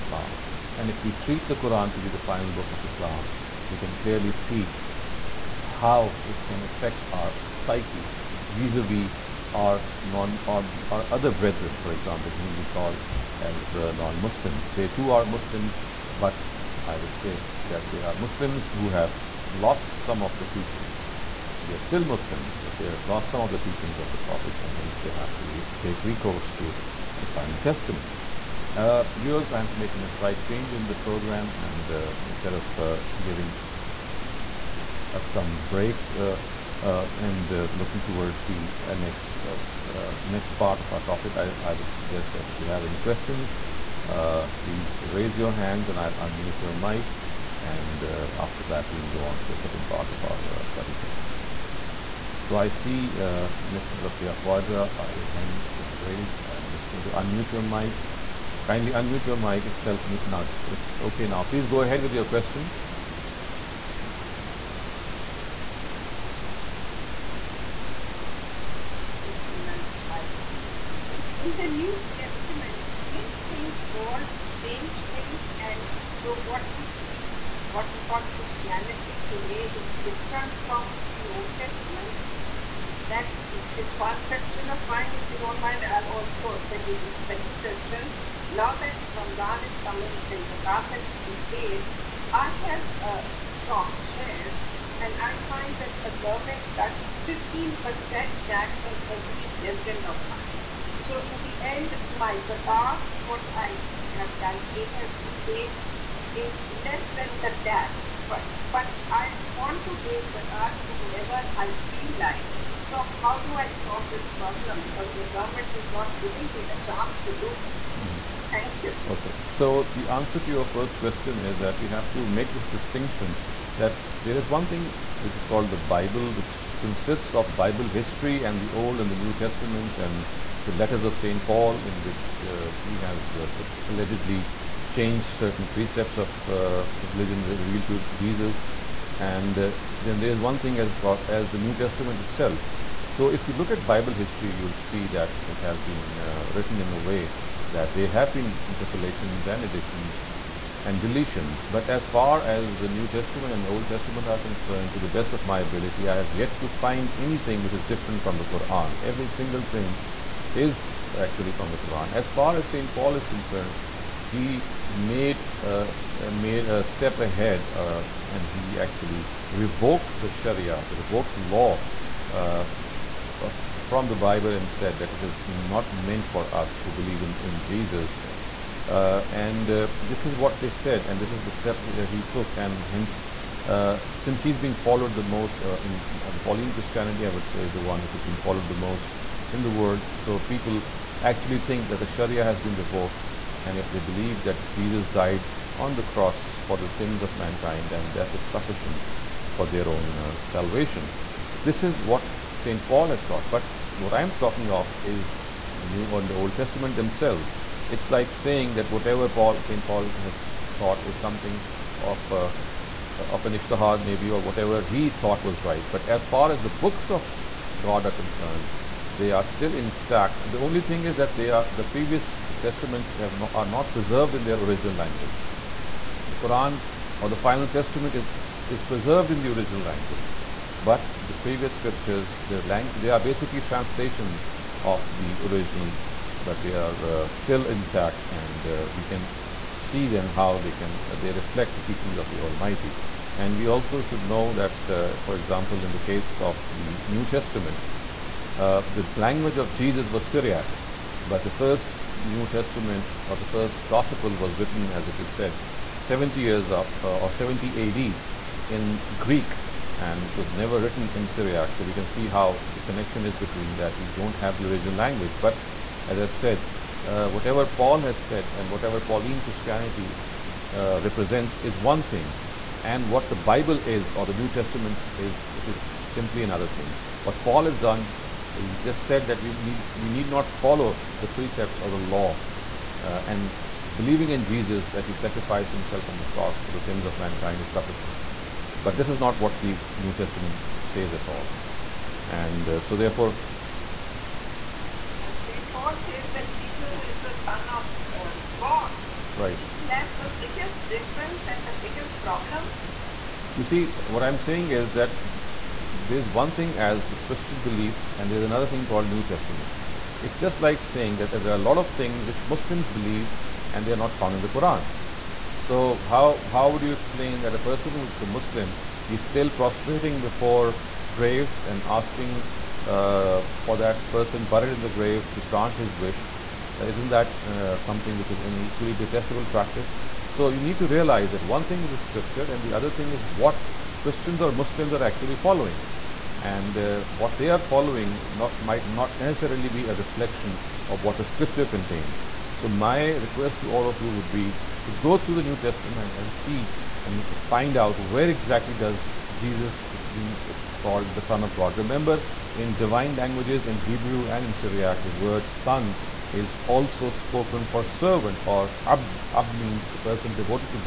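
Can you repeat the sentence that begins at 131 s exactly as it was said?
Paul, in which uh, he has uh, allegedly changed certain precepts of uh, the religion revealed to Jesus.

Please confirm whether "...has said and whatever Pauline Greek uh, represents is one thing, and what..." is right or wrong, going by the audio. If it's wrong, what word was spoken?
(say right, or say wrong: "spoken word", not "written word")
wrong: "Christianity", not "Greek".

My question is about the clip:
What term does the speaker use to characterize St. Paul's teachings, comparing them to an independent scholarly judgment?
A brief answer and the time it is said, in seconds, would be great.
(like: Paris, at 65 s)
ijtihad, at 213 s.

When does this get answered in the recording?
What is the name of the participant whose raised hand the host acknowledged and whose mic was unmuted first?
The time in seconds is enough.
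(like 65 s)
53 s.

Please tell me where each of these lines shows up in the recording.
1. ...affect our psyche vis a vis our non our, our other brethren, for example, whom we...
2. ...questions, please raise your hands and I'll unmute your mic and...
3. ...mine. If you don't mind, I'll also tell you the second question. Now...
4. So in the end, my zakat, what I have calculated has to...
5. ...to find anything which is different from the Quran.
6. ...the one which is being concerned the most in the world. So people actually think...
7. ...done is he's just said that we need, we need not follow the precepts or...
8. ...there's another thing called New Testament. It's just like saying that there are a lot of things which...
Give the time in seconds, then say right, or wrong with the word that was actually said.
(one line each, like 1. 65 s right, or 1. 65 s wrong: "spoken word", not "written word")
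1. 6 s right
2. 42 s right
3. 84 s right
4. 100 s right
5. 156 s right
6. 187 s wrong: "followed", not "concerned"
7. 277 s right
8. 308 s right.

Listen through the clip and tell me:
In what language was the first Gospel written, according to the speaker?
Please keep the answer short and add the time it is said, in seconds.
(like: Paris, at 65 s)
Greek, at 259 s.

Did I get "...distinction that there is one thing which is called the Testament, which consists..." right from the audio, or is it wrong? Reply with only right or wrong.
wrong.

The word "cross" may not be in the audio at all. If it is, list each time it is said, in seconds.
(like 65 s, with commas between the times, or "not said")
196 s, 286 s.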